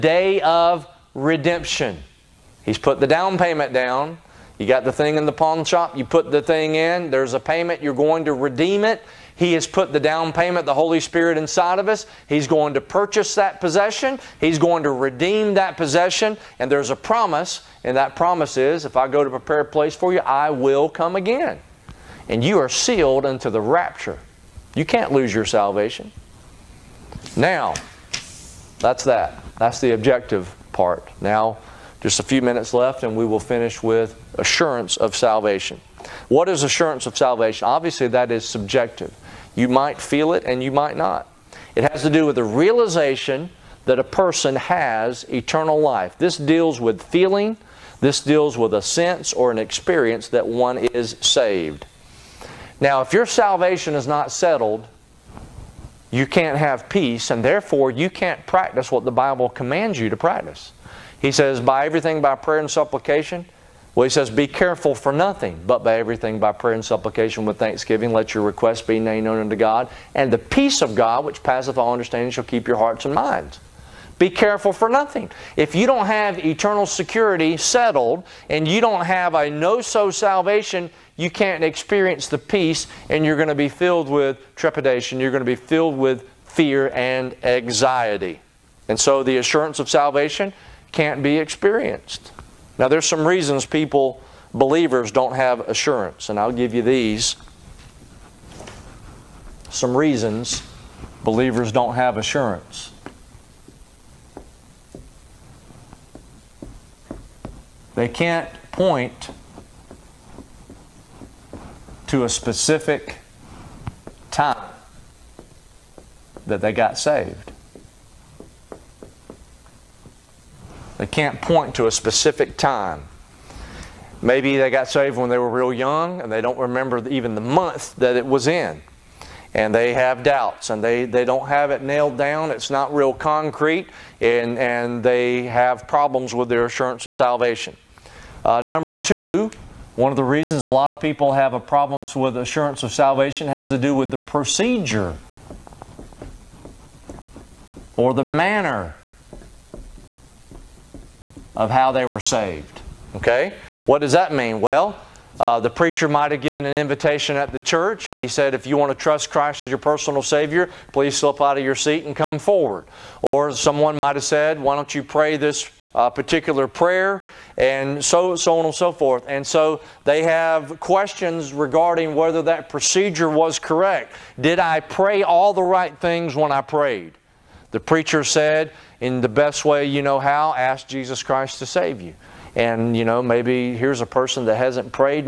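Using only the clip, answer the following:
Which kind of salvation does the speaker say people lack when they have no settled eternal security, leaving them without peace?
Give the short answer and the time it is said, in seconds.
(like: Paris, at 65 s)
A know so salvation, at 79 s.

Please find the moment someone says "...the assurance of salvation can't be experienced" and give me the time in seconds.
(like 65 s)
89 s.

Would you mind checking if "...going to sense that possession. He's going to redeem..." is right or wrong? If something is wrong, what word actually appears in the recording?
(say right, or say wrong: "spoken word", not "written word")
wrong: "purchase", not "sense".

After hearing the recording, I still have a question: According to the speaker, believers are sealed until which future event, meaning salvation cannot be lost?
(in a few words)
The rapture.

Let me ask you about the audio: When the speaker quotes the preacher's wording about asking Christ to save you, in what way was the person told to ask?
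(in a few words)
The best way you know how.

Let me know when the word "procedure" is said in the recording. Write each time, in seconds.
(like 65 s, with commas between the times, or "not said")
144 s, 172 s.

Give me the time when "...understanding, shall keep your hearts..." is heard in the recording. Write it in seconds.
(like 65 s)
71 s.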